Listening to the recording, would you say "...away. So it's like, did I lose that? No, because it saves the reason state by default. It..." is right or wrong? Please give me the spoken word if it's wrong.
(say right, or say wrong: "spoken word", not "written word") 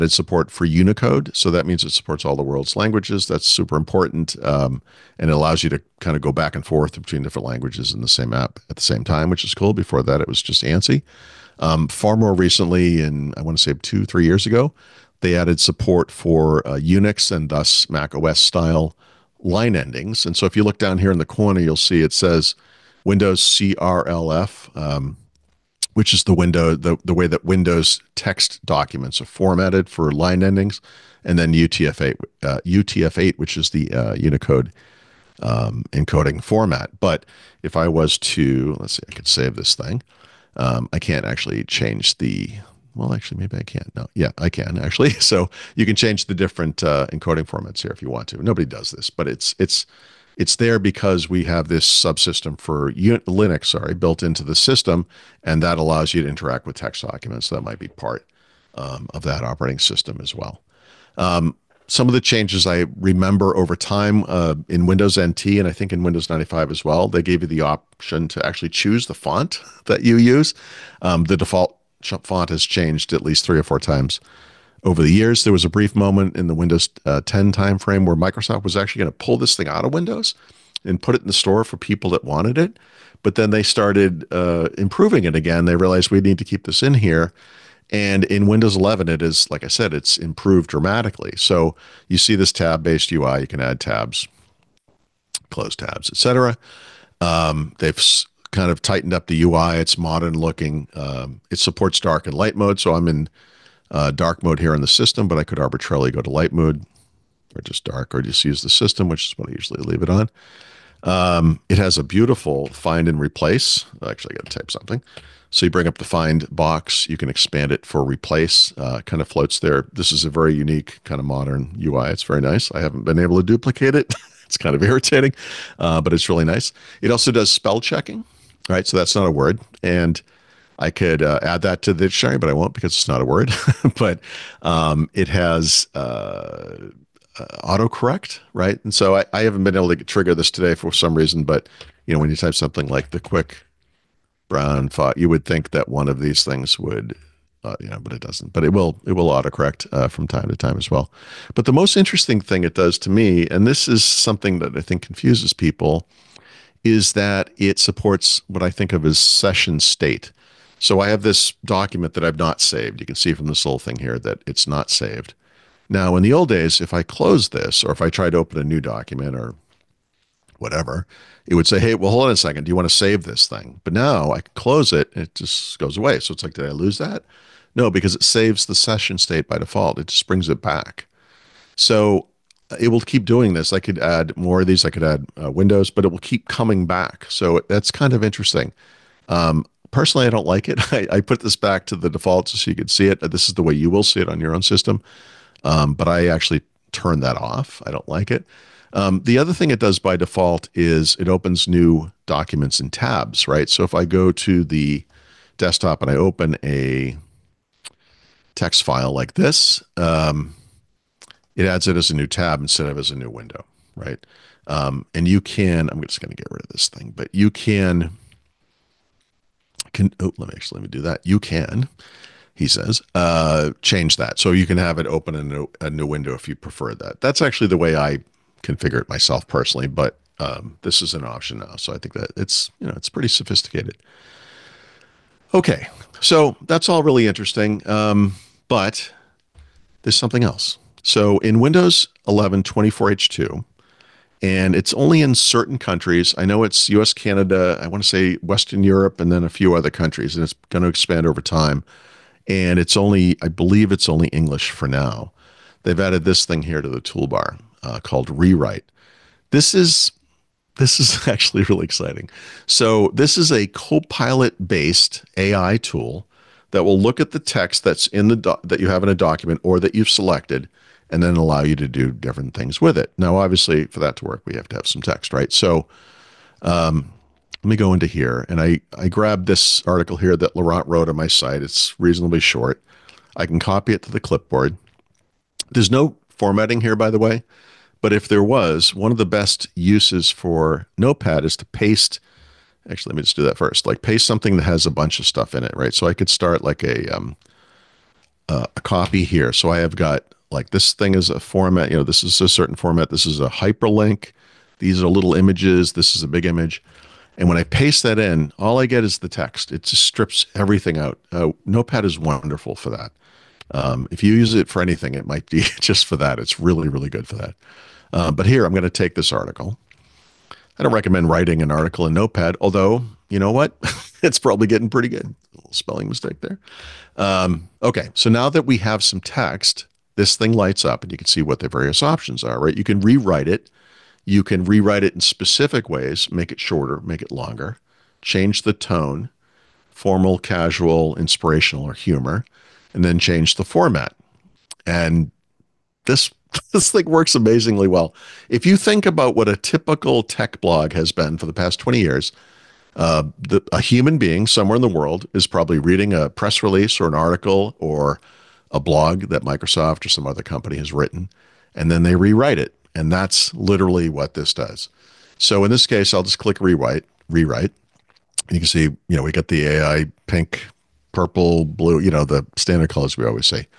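wrong: "session", not "reason".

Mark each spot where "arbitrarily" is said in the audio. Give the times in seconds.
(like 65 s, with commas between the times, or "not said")
105 s.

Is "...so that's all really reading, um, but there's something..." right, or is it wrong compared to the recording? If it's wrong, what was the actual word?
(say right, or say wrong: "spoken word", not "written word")
wrong: "interesting", not "reading".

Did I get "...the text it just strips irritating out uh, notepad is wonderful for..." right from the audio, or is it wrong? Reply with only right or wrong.
wrong.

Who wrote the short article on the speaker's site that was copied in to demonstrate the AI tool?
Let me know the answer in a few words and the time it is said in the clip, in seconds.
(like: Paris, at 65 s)
Laurent, at 280 s.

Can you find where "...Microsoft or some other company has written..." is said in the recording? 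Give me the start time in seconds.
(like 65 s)
359 s.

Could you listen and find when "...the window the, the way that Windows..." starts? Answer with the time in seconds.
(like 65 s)
26 s.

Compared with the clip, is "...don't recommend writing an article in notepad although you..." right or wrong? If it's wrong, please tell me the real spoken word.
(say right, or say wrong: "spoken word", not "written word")
right.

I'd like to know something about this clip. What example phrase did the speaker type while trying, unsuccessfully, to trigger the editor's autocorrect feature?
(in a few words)
the quick brown font.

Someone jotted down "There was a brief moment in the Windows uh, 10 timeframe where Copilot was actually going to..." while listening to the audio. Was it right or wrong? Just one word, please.
wrong.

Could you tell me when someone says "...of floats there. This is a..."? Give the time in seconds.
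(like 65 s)
119 s.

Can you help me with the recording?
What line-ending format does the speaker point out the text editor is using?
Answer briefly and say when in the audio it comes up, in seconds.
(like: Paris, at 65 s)
Windows CRLF, at 23 s.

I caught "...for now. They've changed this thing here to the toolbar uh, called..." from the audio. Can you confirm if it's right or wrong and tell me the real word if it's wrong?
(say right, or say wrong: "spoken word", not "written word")
wrong: "added", not "changed".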